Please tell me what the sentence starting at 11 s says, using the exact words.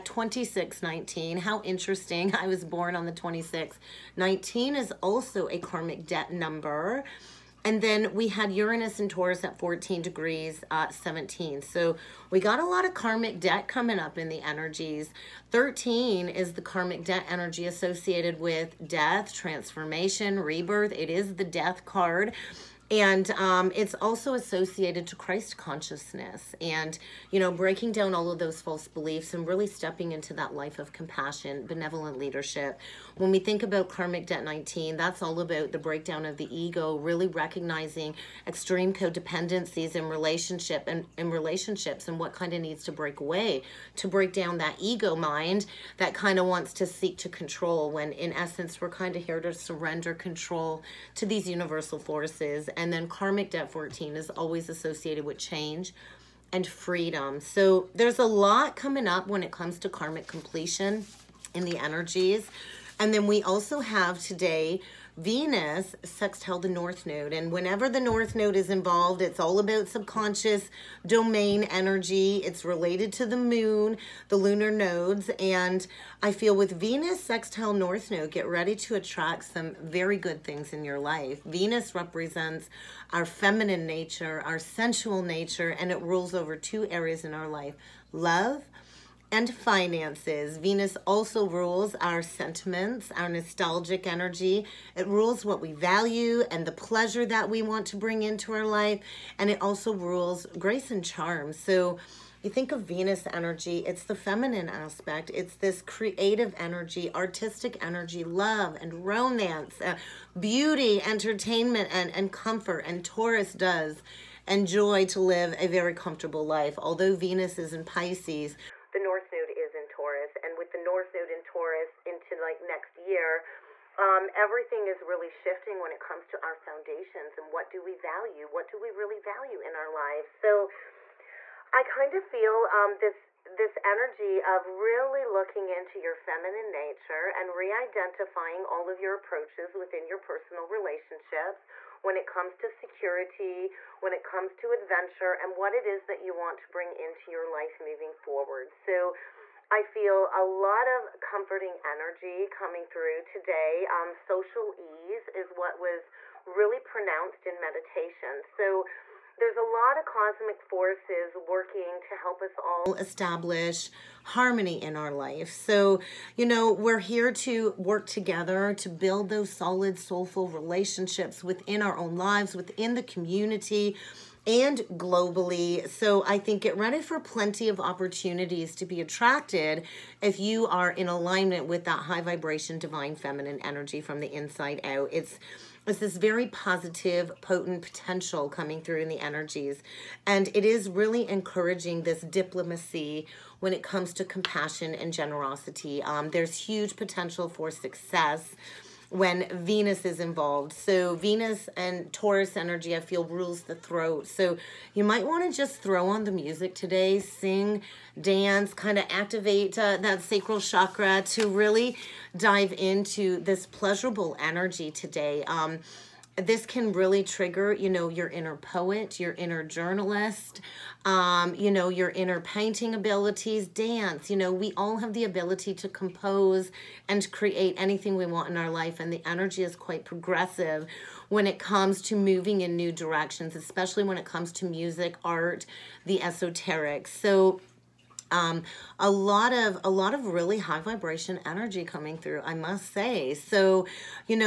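So we got a lot of karmic debt coming up in the energies.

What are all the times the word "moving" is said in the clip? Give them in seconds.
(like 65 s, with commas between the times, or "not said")
147 s, 232 s.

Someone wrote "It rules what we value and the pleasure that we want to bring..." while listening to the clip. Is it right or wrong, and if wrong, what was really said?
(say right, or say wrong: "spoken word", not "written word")
right.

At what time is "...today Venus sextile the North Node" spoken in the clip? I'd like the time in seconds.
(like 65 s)
64 s.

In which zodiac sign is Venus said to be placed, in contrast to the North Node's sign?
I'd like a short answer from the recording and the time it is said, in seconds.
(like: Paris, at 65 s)
Pisces, at 117 s.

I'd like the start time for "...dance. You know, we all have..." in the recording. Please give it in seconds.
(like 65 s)
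223 s.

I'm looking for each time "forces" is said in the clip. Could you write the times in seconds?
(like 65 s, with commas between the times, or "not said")
51 s, 160 s.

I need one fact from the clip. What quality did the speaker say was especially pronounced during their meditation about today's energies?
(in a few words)
Social ease.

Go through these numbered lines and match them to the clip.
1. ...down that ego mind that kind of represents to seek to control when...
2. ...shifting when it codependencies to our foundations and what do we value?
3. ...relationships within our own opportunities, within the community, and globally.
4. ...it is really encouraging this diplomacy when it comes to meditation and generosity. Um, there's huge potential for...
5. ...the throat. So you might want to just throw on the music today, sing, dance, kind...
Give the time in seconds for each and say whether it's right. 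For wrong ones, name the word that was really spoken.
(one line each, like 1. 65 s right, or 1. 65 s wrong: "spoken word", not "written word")
1. 44 s wrong: "wants", not "represents"
2. 125 s wrong: "comes", not "codependencies"
3. 170 s wrong: "lives", not "opportunities"
4. 190 s wrong: "compassion", not "meditation"
5. 203 s right.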